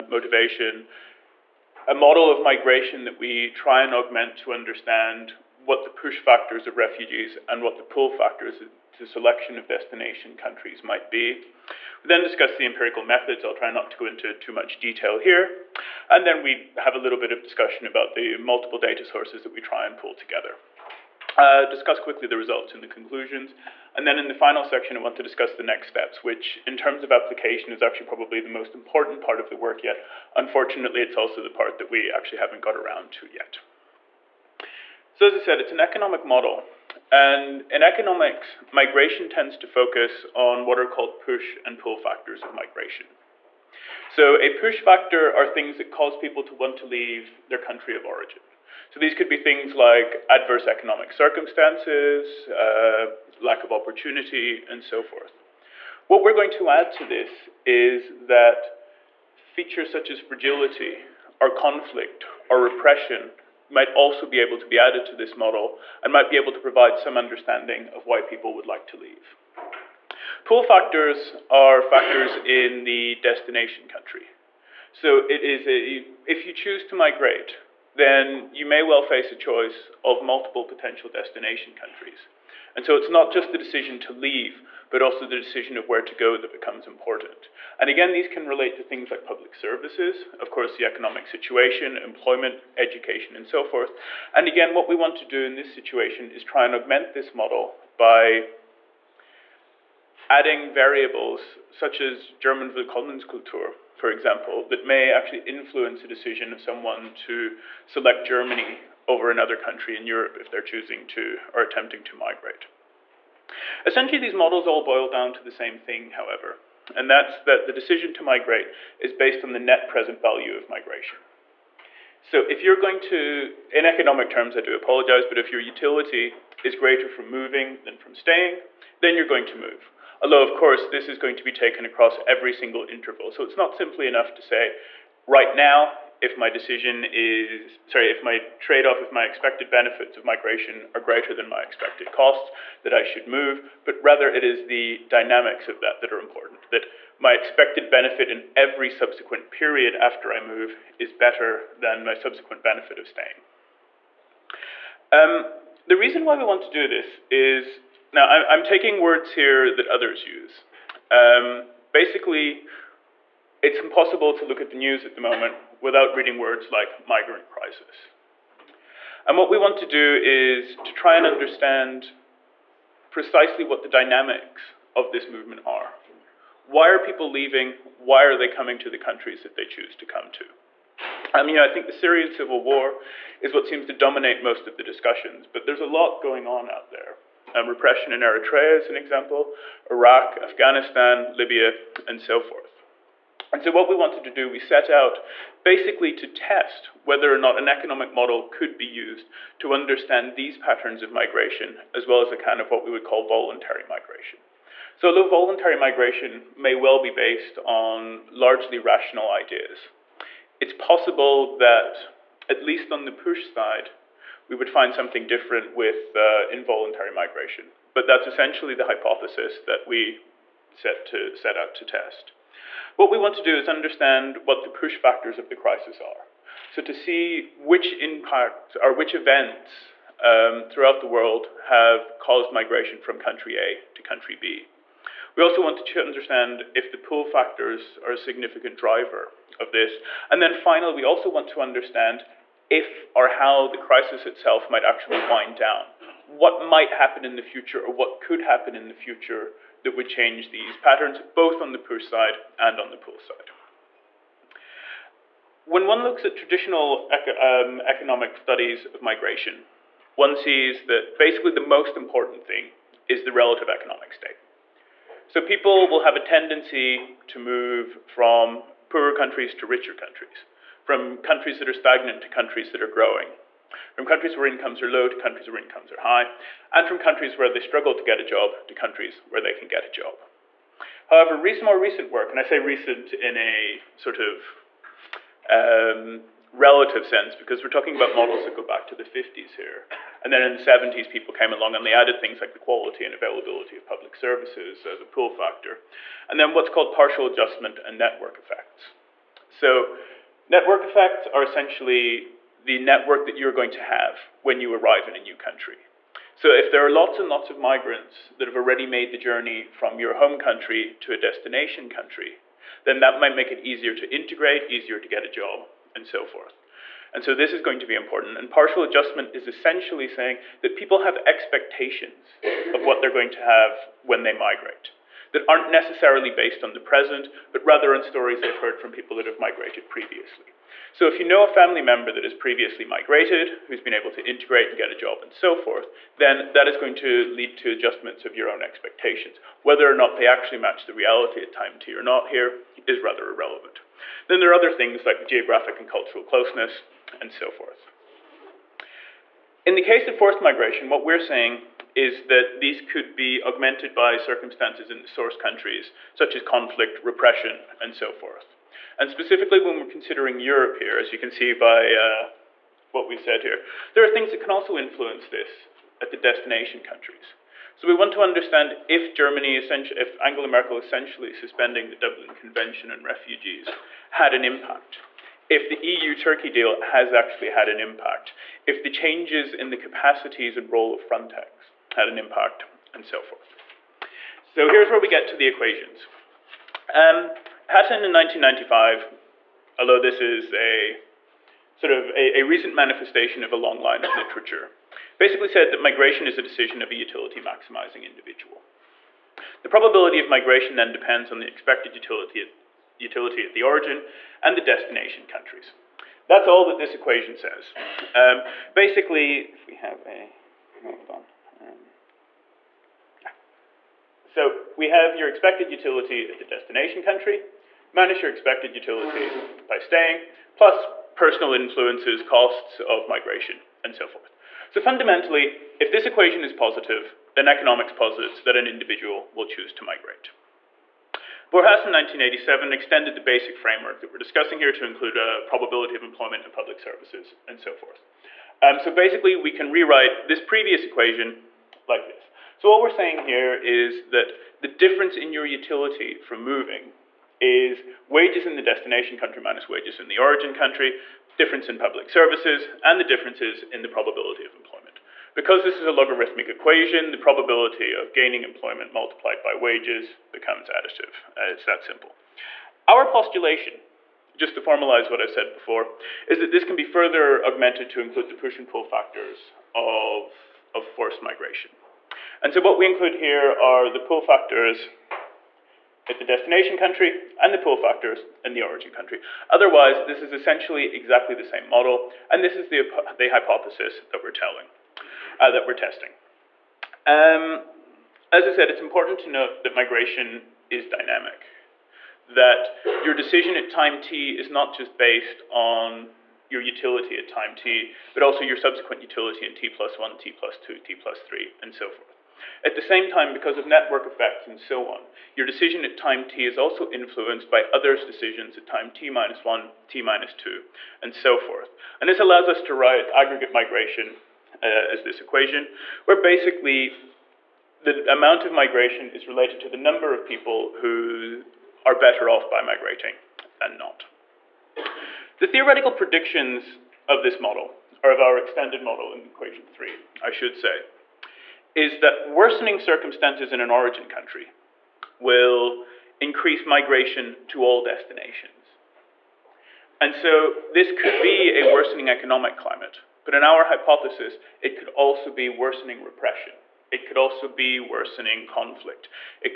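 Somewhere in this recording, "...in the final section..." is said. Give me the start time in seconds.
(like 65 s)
24 s.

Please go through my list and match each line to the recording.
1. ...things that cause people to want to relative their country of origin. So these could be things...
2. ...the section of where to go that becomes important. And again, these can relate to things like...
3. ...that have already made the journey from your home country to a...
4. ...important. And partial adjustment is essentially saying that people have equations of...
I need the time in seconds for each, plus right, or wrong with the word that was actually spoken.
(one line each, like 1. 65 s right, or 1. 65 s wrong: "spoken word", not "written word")
1. 45 s wrong: "leave", not "relative"
2. 85 s wrong: "decision", not "section"
3. 308 s right
4. 317 s wrong: "expectations", not "equations".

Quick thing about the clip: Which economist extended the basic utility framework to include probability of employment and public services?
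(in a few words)
Borjas.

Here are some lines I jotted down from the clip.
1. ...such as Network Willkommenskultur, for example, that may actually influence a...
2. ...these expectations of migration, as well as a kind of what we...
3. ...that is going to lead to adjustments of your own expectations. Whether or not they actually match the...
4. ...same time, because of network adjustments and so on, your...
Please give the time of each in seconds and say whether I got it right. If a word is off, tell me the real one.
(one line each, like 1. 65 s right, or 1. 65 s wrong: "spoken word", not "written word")
1. 101 s wrong: "German", not "Network"
2. 200 s wrong: "patterns", not "expectations"
3. 336 s right
4. 502 s wrong: "effects", not "adjustments".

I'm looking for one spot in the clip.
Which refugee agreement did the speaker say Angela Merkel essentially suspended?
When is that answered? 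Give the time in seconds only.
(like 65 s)
371 s.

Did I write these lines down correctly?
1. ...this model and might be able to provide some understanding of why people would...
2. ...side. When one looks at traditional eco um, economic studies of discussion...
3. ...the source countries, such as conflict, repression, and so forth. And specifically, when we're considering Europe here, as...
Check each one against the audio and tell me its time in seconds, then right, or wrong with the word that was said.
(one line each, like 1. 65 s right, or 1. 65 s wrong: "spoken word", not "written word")
1. 65 s right
2. 253 s wrong: "migration", not "discussion"
3. 354 s right.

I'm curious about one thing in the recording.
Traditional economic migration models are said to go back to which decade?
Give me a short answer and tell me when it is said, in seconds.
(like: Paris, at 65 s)
1950s, at 288 s.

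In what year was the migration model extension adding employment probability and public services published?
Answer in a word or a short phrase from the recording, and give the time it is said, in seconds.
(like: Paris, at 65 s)
1987, at 431 s.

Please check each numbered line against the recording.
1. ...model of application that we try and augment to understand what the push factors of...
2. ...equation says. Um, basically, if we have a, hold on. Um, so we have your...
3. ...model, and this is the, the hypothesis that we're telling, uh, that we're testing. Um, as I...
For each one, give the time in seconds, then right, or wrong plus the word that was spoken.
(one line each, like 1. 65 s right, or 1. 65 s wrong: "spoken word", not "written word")
1. 1 s wrong: "migration", not "application"
2. 406 s right
3. 481 s right.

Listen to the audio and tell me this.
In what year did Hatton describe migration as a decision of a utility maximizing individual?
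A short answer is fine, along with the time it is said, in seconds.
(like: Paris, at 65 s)
1995, at 388 s.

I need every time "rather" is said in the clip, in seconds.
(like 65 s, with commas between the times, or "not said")
144 s, 327 s, 343 s.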